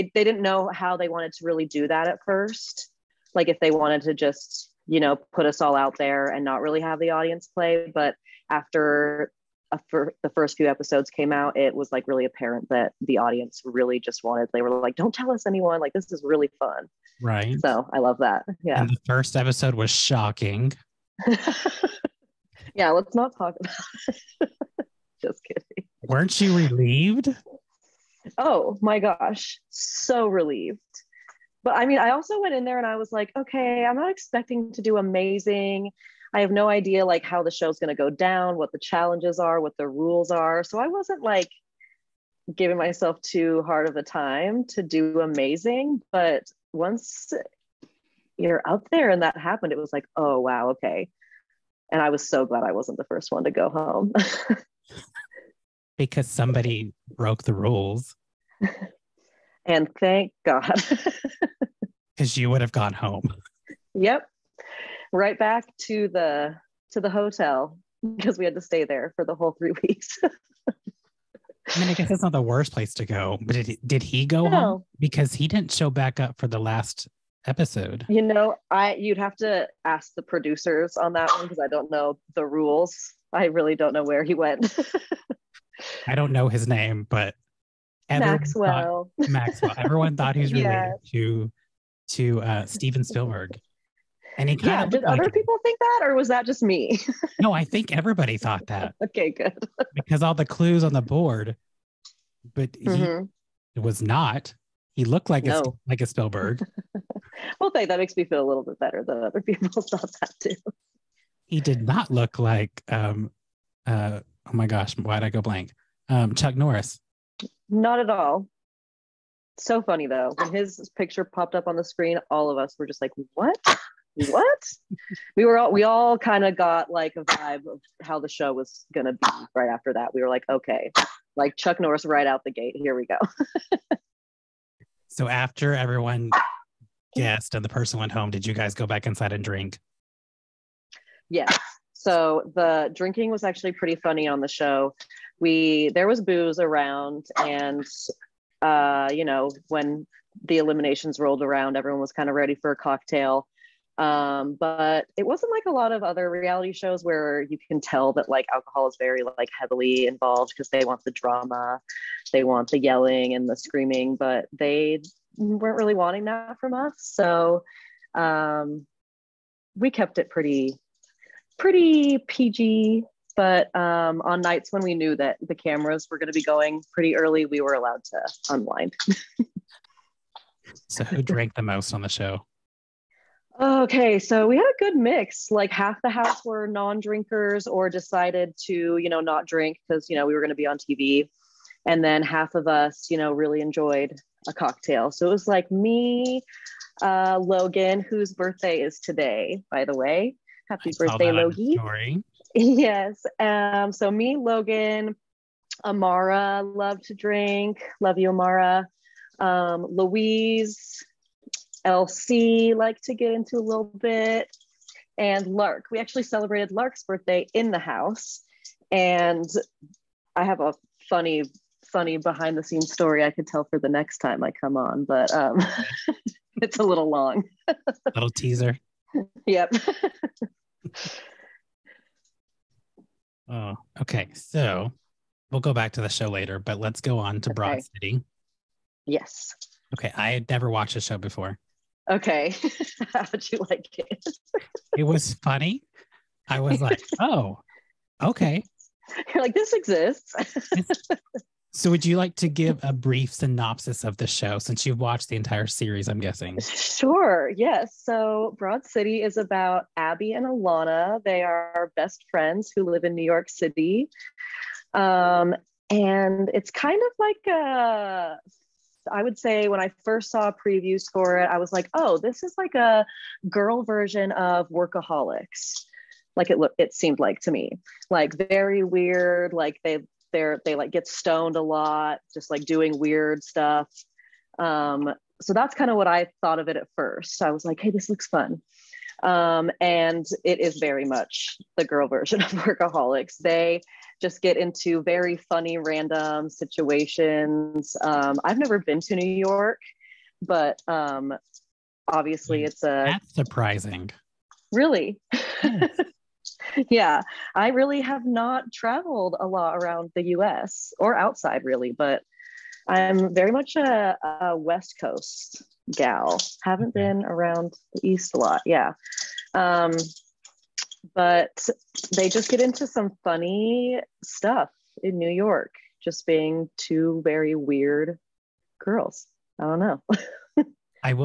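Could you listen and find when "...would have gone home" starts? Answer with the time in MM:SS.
01:02.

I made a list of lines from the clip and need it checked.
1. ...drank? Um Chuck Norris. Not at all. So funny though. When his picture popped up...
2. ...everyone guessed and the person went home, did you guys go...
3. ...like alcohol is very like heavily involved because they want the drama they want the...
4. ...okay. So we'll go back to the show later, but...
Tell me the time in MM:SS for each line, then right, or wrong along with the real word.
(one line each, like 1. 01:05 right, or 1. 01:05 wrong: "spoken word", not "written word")
1. 01:55 wrong: "blank", not "drank"
2. 02:15 right
3. 02:38 right
4. 03:54 right.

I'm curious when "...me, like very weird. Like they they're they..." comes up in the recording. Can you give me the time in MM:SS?
04:37.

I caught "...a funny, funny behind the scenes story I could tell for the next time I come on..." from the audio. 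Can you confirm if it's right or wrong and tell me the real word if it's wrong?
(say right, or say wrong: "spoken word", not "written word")
right.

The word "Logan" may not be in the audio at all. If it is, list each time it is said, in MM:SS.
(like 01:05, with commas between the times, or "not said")
03:17, 03:24.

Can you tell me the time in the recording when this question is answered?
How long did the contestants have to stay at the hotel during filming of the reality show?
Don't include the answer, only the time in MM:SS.
01:09.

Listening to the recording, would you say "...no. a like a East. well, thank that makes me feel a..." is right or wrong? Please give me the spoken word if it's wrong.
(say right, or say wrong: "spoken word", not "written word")
wrong: "Spielberg", not "East".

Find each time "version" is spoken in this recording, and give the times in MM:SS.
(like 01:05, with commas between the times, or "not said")
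04:33, 04:52.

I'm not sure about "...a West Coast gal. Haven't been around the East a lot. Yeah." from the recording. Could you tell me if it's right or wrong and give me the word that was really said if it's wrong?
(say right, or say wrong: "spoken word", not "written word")
right.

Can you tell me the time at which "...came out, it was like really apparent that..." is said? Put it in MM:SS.
00:11.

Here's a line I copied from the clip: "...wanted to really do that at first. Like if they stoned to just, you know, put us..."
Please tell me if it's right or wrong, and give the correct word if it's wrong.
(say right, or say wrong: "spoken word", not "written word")
wrong: "wanted", not "stoned".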